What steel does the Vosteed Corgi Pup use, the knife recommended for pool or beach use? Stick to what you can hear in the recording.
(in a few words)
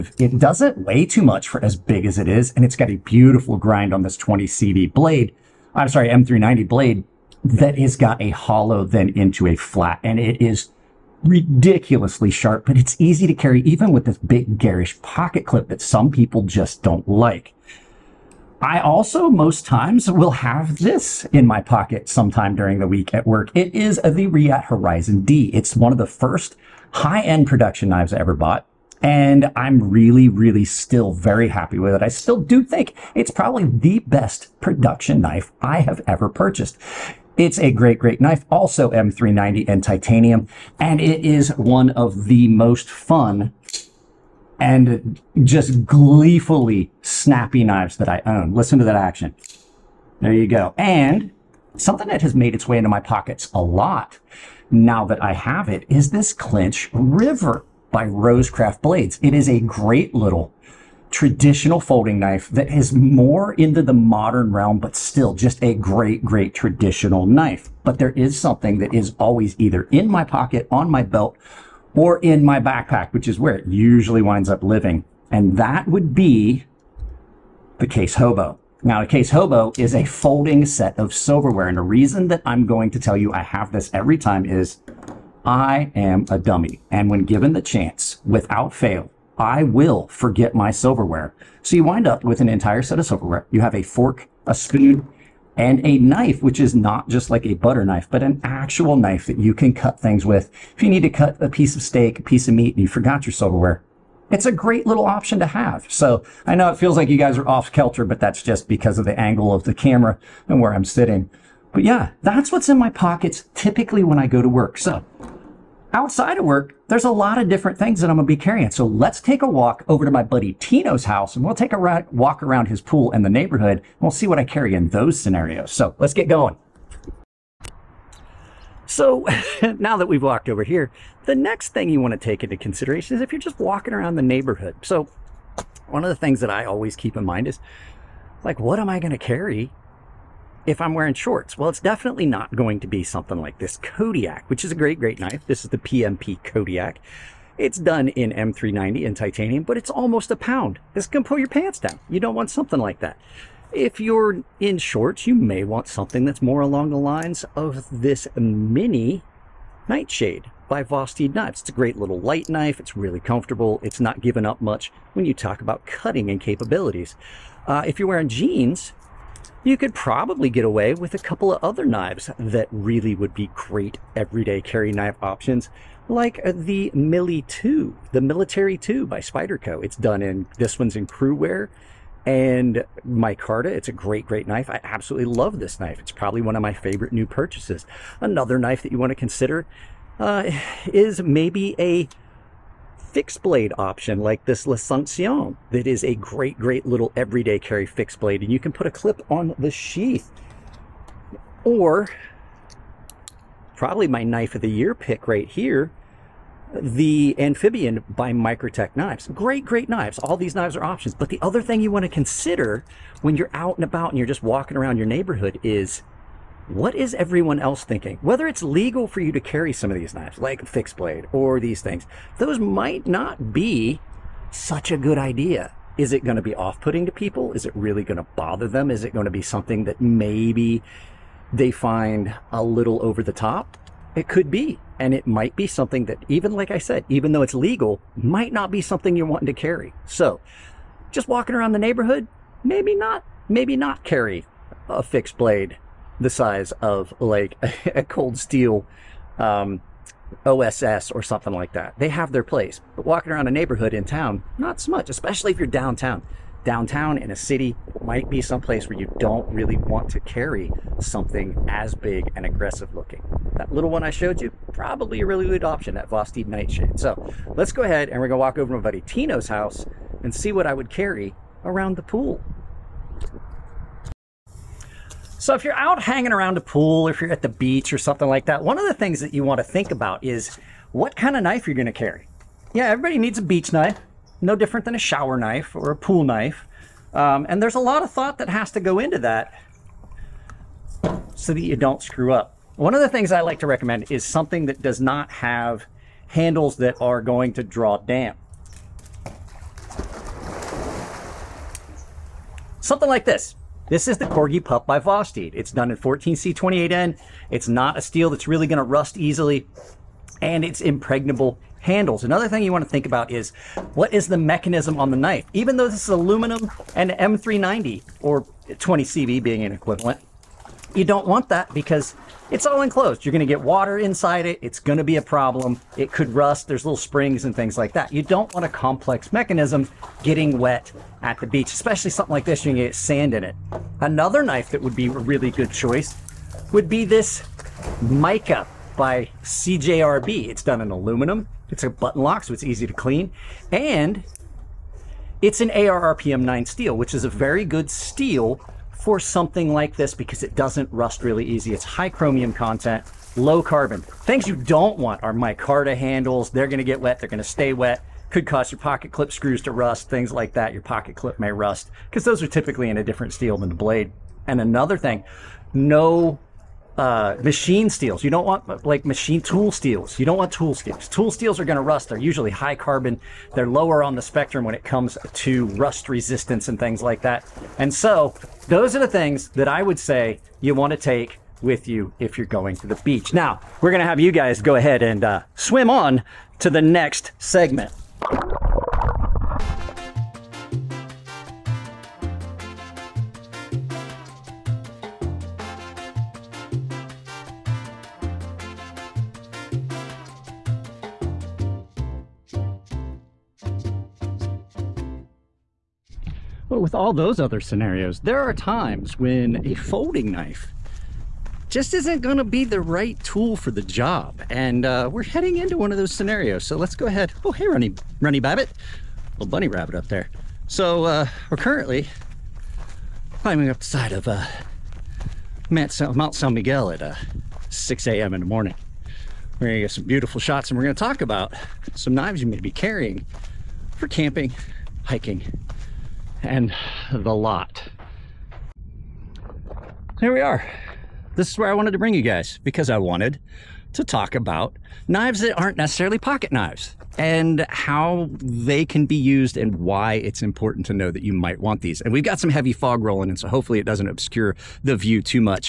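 14C28N.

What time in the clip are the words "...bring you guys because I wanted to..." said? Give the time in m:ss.
7:21.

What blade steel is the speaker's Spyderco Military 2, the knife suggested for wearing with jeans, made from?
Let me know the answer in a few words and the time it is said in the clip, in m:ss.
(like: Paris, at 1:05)
Cru-Wear, at 3:01.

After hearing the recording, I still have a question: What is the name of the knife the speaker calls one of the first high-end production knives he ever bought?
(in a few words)
Reate Horizon D.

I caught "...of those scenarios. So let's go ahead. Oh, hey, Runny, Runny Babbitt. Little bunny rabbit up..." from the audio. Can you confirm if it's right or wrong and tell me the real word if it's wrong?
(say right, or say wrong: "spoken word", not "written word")
right.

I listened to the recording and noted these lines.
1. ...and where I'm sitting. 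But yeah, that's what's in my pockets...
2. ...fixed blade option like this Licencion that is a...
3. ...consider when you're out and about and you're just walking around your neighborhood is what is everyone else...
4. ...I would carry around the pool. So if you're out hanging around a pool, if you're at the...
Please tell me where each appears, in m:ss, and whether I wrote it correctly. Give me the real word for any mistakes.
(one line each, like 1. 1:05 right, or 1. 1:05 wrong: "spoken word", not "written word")
1. 1:50 right
2. 3:13 right
3. 3:32 right
4. 4:30 right.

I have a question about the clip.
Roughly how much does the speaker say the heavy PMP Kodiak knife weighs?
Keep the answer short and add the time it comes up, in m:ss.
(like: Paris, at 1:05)
Almost a pound, at 2:29.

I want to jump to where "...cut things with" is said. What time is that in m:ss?
1:39.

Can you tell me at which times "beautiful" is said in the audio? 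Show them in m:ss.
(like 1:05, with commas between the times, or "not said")
0:02, 7:10.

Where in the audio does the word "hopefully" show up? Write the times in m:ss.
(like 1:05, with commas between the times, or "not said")
7:33.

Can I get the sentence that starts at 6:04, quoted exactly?
And another thing, no uh, machine steels.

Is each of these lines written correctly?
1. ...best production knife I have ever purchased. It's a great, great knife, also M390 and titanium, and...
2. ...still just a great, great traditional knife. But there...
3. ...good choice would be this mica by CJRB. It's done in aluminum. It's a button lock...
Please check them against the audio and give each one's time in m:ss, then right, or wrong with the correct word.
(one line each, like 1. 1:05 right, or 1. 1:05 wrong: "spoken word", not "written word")
1. 0:33 right
2. 1:04 right
3. 5:35 right.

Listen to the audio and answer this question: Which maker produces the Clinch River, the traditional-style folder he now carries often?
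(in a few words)
Rosecraft Blades.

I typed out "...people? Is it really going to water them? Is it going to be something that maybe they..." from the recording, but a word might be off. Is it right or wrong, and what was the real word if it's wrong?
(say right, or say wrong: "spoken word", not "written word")
wrong: "bother", not "water".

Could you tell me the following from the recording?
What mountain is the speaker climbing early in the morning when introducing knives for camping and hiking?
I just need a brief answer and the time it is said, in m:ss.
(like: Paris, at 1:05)
Mount San Miguel, at 7:05.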